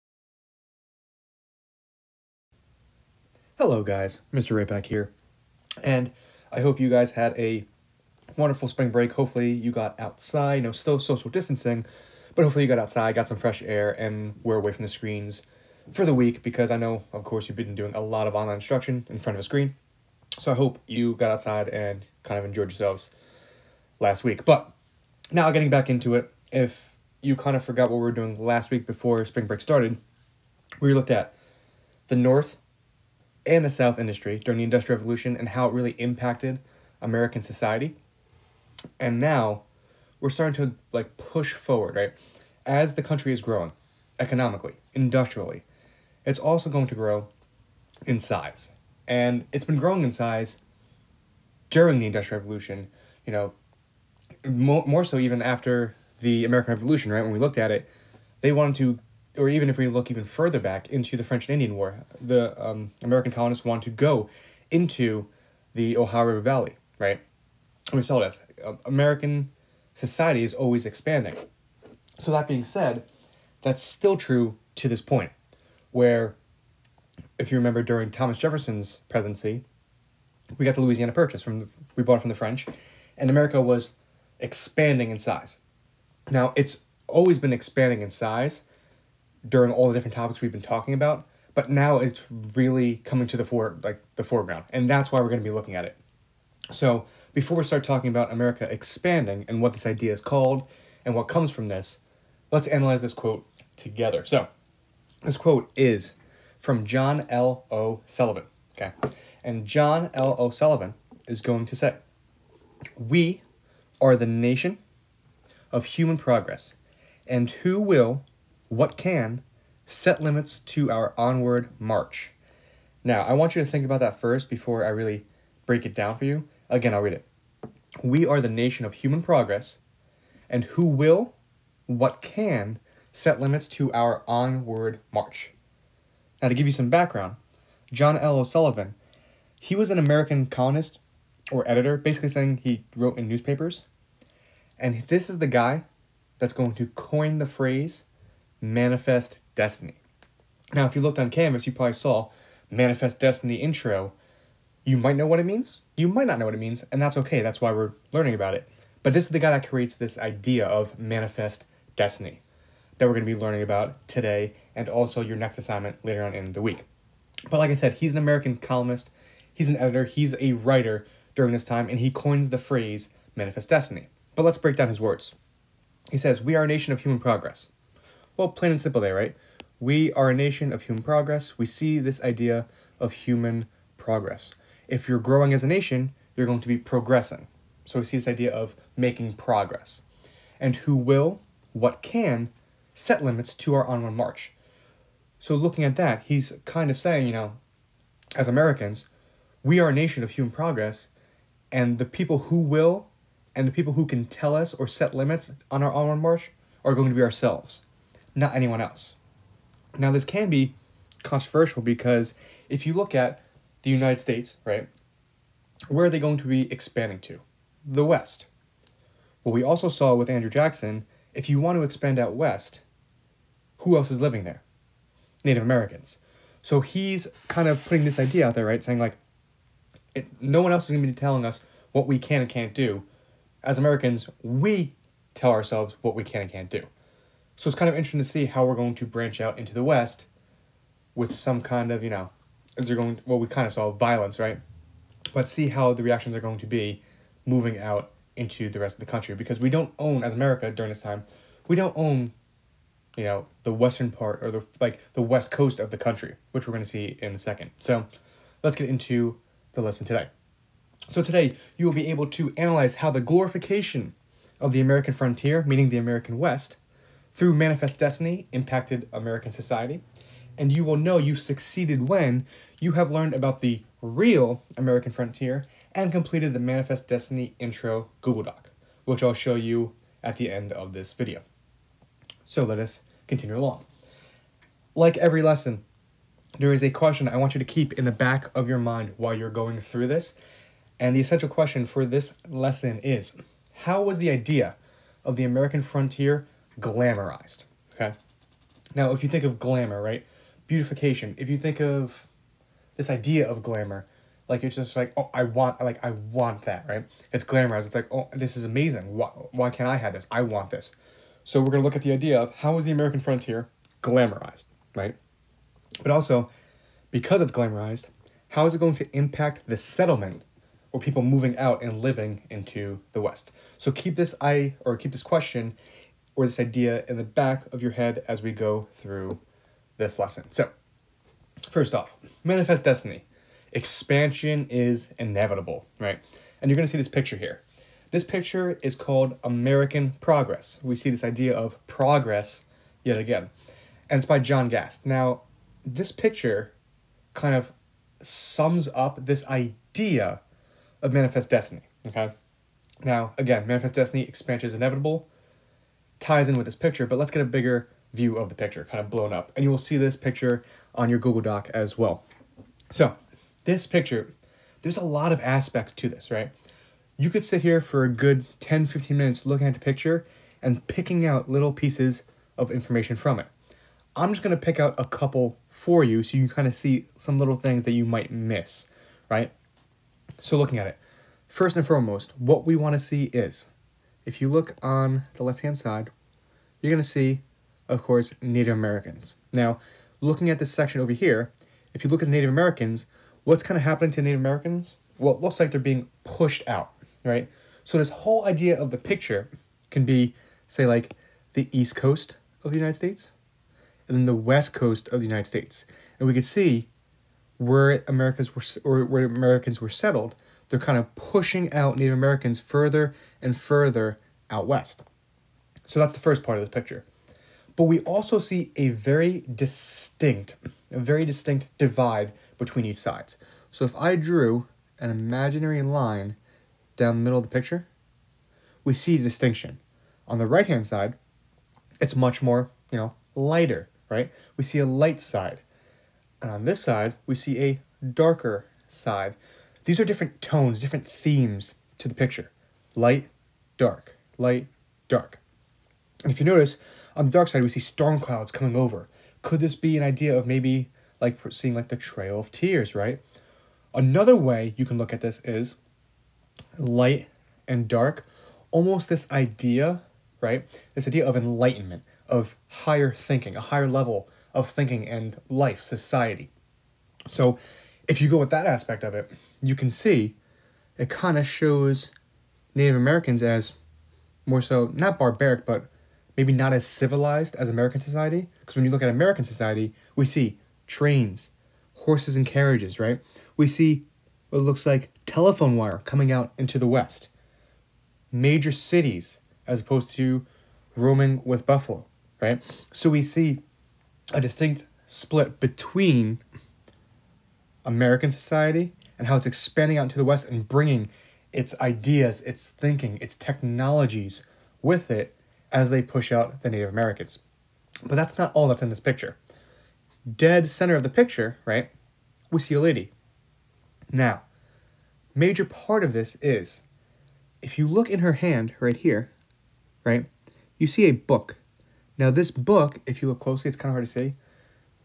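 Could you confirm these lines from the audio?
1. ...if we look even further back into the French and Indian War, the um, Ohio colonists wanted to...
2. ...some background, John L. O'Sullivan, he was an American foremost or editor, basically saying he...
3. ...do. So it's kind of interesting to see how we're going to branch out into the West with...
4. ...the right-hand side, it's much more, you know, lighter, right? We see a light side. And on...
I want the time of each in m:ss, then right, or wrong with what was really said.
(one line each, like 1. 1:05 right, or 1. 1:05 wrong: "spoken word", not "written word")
1. 0:59 wrong: "American", not "Ohio"
2. 2:16 wrong: "columnist", not "foremost"
3. 3:56 right
4. 7:10 right.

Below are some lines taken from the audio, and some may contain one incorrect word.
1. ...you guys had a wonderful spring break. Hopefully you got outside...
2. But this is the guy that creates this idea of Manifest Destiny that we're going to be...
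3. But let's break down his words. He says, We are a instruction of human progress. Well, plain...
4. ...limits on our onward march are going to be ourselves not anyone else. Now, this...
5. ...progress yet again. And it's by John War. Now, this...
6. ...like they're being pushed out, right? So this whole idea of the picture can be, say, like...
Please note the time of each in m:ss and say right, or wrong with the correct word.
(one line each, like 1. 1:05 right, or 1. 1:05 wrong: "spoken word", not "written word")
1. 0:06 right
2. 2:39 right
3. 2:54 wrong: "nation", not "instruction"
4. 3:25 right
5. 5:41 wrong: "Gast", not "War"
6. 6:35 right.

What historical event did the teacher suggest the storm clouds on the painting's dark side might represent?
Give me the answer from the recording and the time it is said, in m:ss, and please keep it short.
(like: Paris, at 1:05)
Trail of Tears, at 7:31.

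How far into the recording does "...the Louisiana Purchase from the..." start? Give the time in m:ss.
1:20.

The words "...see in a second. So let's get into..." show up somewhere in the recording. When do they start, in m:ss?
4:16.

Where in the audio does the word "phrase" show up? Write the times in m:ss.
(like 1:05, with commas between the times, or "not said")
2:27, 2:52.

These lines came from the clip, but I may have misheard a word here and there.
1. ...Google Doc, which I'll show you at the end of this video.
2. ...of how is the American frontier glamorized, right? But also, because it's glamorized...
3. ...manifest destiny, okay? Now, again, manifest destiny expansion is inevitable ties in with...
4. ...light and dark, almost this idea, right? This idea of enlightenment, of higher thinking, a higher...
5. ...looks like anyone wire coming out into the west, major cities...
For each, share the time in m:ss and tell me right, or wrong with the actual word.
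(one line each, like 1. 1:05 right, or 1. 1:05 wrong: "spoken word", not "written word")
1. 4:38 right
2. 5:12 right
3. 5:51 right
4. 7:36 right
5. 8:04 wrong: "telephone", not "anyone".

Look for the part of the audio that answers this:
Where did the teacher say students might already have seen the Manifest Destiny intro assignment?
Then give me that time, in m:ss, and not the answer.
2:31.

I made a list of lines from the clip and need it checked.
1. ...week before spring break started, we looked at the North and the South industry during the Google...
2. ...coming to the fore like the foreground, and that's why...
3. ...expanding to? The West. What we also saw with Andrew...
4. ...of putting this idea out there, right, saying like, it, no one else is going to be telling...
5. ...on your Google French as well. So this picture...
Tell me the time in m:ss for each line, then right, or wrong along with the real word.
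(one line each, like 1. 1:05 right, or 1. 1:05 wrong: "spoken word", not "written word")
1. 0:28 wrong: "Industrial", not "Google"
2. 1:33 right
3. 3:36 right
4. 3:47 right
5. 6:00 wrong: "Doc", not "French".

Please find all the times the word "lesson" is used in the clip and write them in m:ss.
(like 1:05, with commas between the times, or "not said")
4:19, 4:45, 4:52, 5:30.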